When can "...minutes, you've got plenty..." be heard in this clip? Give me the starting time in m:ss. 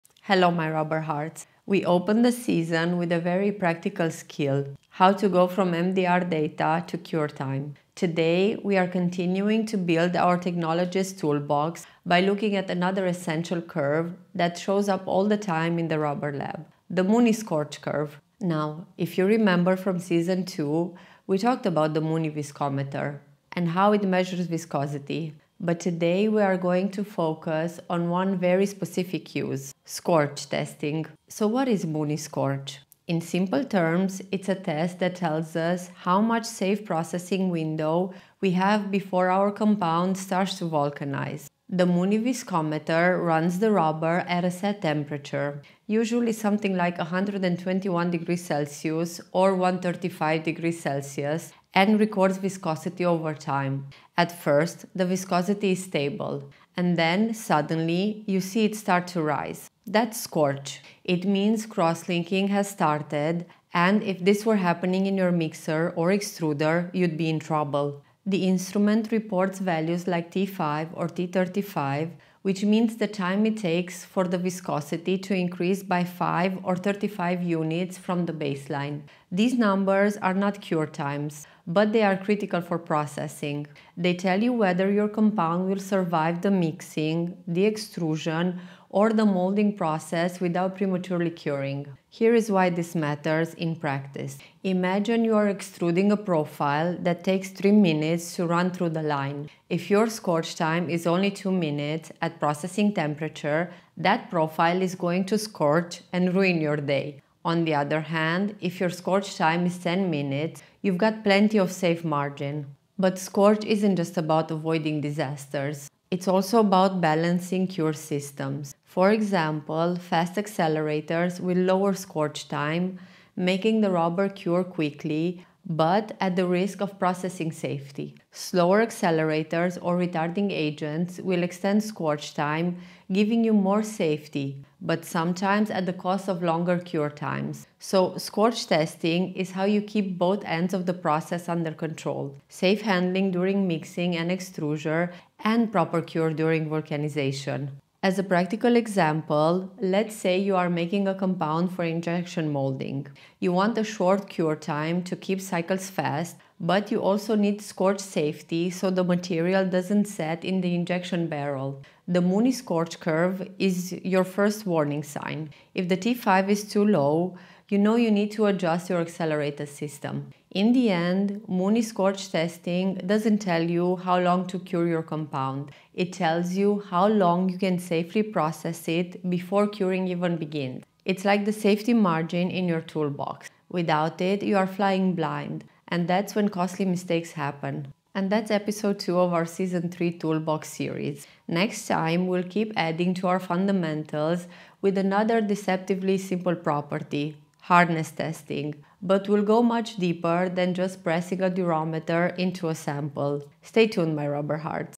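1:50.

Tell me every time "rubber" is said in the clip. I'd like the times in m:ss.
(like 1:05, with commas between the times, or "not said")
0:00, 0:15, 0:43, 2:03, 3:24.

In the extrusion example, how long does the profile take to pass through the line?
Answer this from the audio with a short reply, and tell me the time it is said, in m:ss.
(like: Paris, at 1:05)
3 minutes, at 1:37.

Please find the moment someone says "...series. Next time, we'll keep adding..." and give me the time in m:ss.
3:10.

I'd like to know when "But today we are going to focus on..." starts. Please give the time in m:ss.
0:25.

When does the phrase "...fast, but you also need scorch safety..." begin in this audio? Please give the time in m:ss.
2:35.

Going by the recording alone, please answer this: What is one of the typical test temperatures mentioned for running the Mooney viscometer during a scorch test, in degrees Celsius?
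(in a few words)
121.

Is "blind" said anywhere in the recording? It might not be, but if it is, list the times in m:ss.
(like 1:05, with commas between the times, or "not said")
3:05.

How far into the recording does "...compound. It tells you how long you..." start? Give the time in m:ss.
2:55.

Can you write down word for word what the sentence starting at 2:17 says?
So, scorch testing is how you keep both ends of the process under control.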